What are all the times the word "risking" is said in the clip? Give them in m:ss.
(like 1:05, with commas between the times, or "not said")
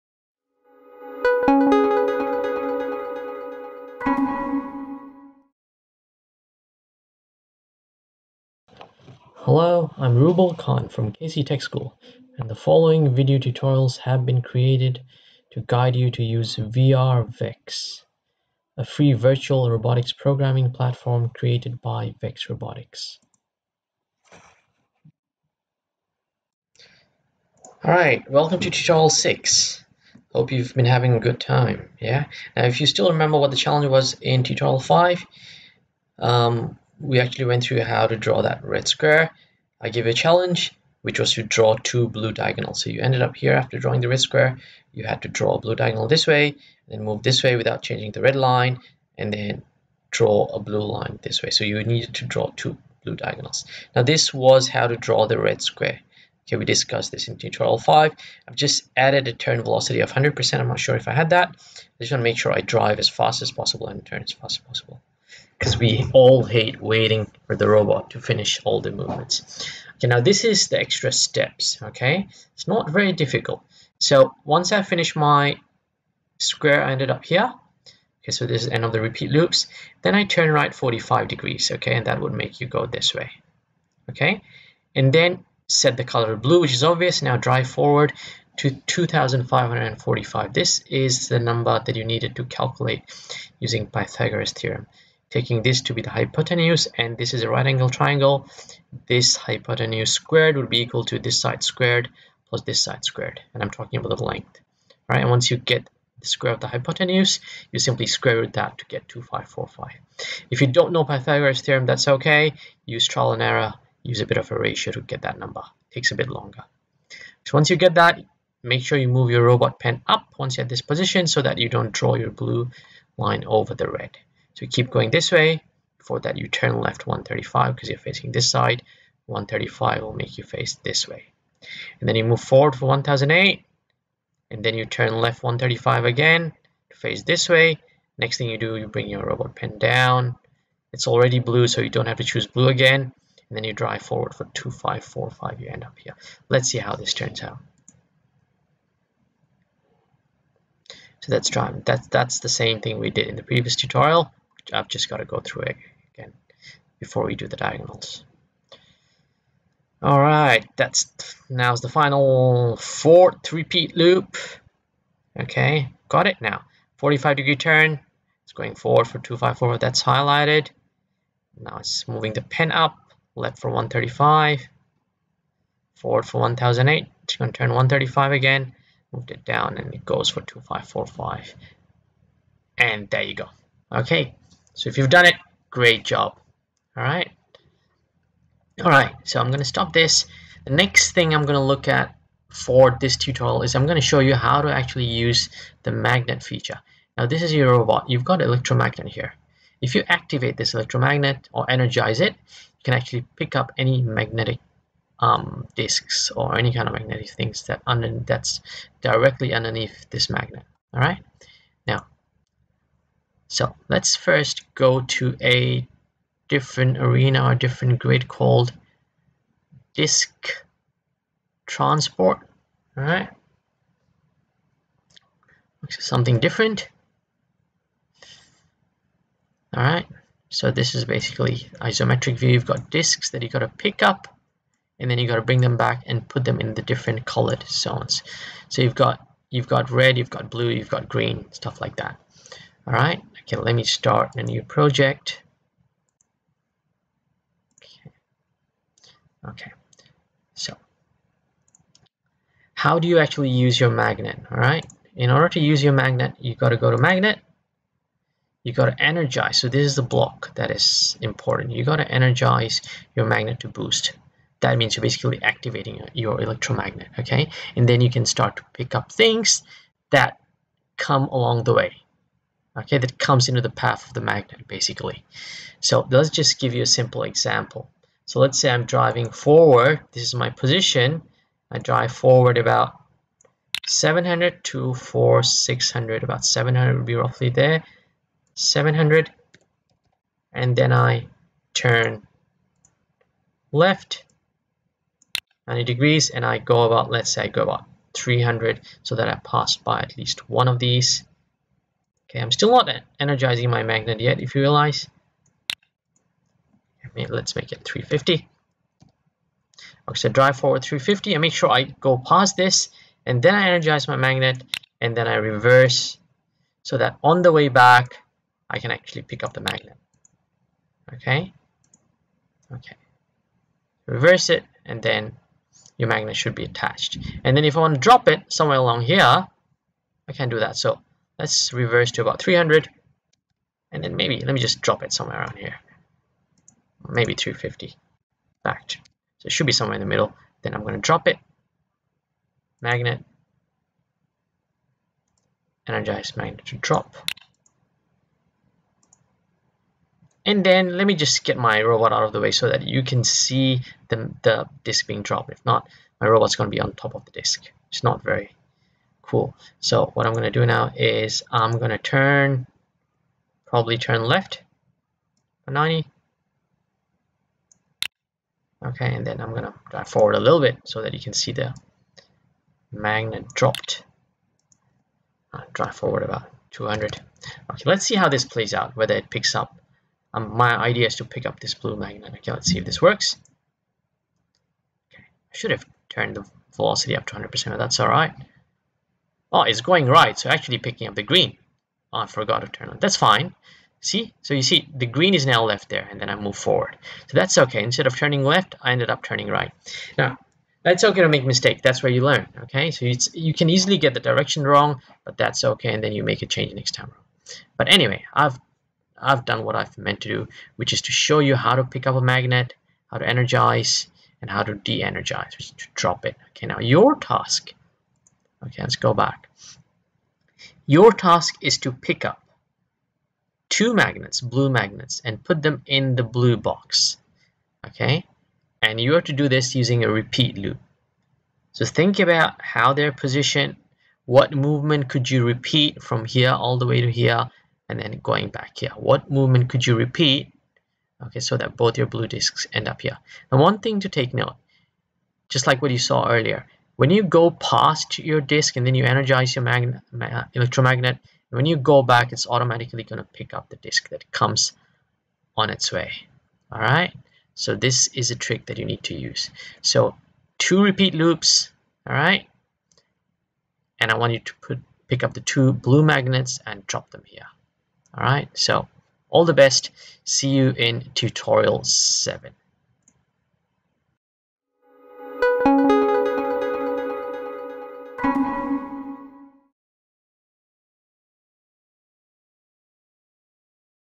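not said.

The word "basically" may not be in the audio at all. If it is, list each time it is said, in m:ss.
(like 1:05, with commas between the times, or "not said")
3:51, 4:25, 4:34.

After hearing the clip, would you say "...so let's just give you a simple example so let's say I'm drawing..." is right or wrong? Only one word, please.
wrong.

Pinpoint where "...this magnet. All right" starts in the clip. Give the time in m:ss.
3:30.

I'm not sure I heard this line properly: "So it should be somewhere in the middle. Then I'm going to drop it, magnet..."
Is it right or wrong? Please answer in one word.
right.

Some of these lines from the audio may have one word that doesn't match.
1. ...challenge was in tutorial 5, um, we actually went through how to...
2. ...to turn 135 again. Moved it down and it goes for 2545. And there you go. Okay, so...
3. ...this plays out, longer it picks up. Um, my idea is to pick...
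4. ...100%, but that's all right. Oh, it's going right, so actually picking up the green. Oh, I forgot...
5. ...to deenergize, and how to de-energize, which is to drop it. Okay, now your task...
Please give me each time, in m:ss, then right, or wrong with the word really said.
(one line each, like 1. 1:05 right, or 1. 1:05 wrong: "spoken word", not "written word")
1. 0:33 right
2. 2:57 right
3. 6:18 wrong: "whether", not "longer"
4. 6:27 right
5. 6:53 wrong: "energize", not "deenergize".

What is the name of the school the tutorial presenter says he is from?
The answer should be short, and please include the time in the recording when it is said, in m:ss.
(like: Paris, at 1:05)
Casey Tech School, at 0:11.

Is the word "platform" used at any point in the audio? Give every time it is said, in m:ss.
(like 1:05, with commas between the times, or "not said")
0:20.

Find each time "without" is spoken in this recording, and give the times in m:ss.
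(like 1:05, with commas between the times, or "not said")
0:47.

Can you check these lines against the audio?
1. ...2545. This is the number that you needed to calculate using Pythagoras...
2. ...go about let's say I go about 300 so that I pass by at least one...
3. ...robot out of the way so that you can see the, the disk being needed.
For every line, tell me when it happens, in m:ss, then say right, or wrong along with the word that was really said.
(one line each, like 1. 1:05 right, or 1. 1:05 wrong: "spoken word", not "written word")
1. 1:28 right
2. 4:56 right
3. 5:51 wrong: "dropped", not "needed".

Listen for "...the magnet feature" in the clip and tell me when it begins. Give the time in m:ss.
3:15.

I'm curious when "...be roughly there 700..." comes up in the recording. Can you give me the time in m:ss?
4:47.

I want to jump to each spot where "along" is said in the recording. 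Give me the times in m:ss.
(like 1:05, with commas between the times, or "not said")
4:31, 5:28.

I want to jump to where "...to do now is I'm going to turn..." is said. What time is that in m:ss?
6:00.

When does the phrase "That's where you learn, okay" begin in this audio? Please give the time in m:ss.
6:41.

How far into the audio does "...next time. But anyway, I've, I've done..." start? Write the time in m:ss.
6:46.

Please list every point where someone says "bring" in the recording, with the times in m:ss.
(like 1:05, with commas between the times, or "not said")
2:18, 3:55.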